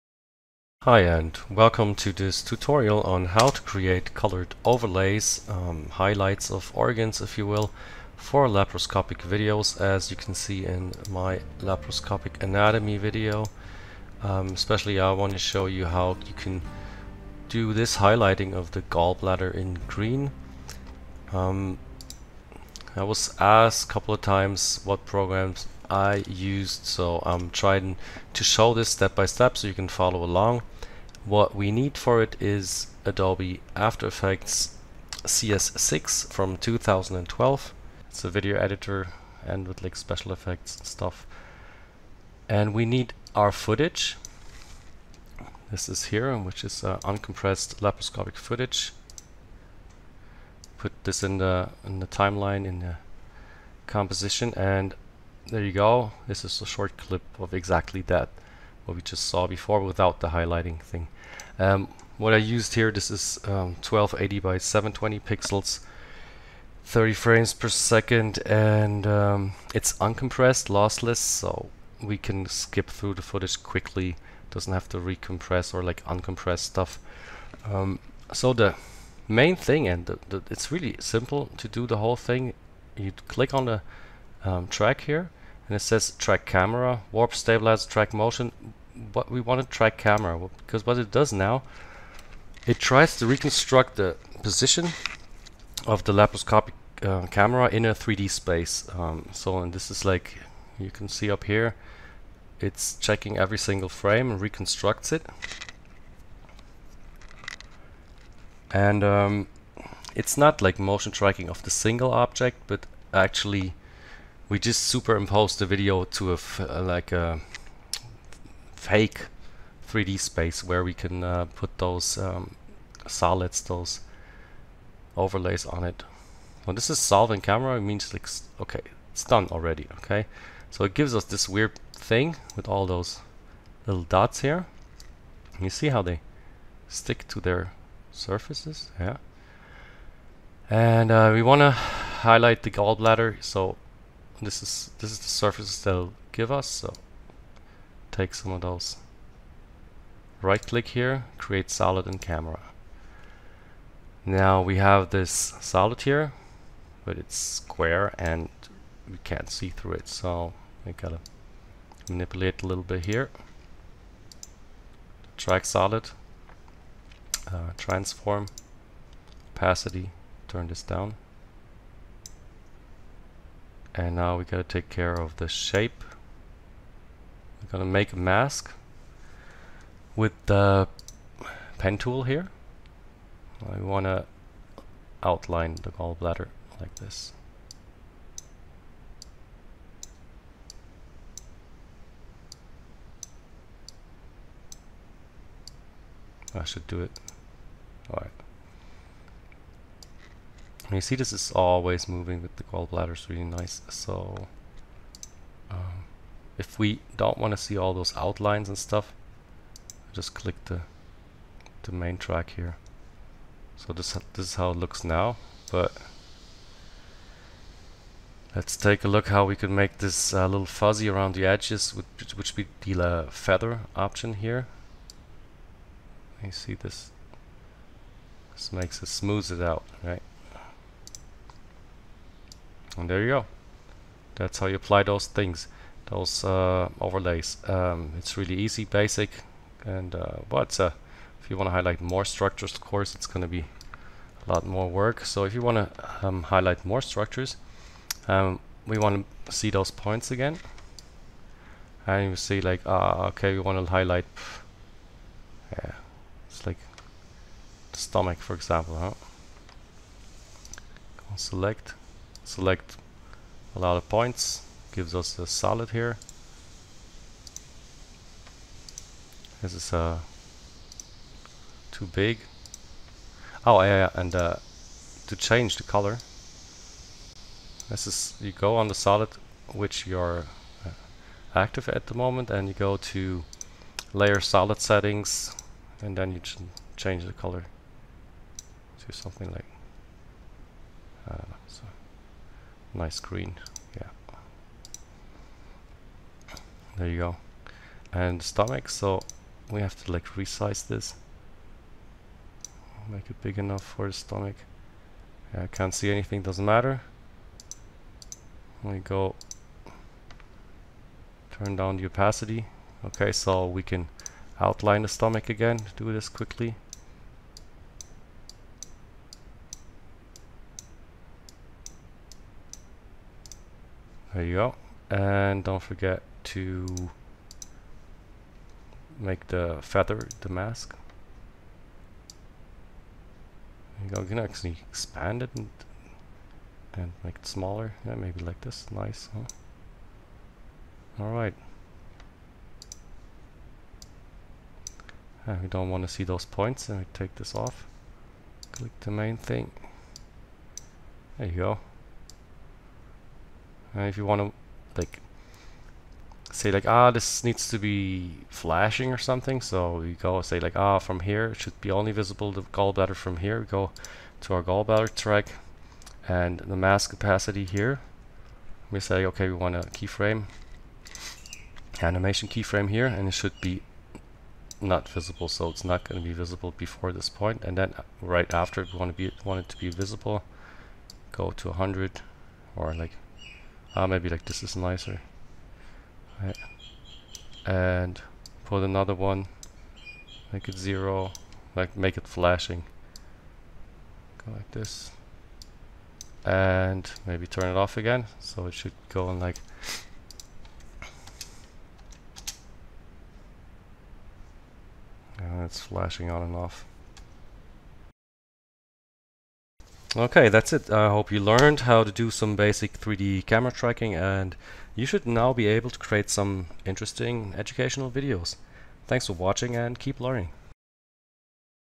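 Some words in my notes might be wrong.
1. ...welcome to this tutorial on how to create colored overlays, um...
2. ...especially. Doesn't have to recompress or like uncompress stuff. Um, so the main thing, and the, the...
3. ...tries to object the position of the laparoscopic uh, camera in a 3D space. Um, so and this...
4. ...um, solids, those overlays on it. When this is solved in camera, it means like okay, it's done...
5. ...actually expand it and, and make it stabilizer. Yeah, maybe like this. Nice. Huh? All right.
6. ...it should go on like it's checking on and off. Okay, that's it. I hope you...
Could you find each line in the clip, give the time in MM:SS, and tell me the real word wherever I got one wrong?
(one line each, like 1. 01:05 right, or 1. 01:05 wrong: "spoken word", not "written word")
1. 00:01 right
2. 01:13 wrong: "quickly", not "especially"
3. 01:32 wrong: "reconstruct", not "object"
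4. 02:02 right
5. 05:34 wrong: "smaller", not "stabilizer"
6. 06:38 wrong: "flashing", not "checking".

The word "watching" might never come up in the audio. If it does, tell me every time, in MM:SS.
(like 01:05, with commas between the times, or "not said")
06:59.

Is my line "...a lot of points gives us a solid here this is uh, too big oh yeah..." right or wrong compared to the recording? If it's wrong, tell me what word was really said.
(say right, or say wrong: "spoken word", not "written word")
right.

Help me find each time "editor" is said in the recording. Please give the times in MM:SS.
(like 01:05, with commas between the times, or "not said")
00:38.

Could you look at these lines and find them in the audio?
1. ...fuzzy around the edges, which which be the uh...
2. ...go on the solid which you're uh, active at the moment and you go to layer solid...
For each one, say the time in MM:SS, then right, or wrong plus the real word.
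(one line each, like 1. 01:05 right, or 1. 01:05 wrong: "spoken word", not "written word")
1. 03:40 right
2. 04:38 right.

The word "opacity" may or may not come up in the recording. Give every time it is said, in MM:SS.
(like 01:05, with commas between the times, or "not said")
02:49, 05:12, 06:07.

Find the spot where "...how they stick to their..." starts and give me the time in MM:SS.
02:15.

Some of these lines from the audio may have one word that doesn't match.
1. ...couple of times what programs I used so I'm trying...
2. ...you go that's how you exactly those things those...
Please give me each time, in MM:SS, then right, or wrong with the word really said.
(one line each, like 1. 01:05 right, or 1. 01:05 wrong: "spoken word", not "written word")
1. 00:23 right
2. 03:53 wrong: "apply", not "exactly".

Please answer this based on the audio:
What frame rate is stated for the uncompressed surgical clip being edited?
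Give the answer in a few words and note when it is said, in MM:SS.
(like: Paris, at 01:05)
30 frames per second, at 01:06.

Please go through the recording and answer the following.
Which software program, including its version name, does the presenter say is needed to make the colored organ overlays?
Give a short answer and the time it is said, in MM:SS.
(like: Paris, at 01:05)
Adobe After Effects CS6, at 00:33.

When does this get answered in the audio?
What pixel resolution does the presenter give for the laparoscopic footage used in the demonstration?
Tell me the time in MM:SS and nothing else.
01:03.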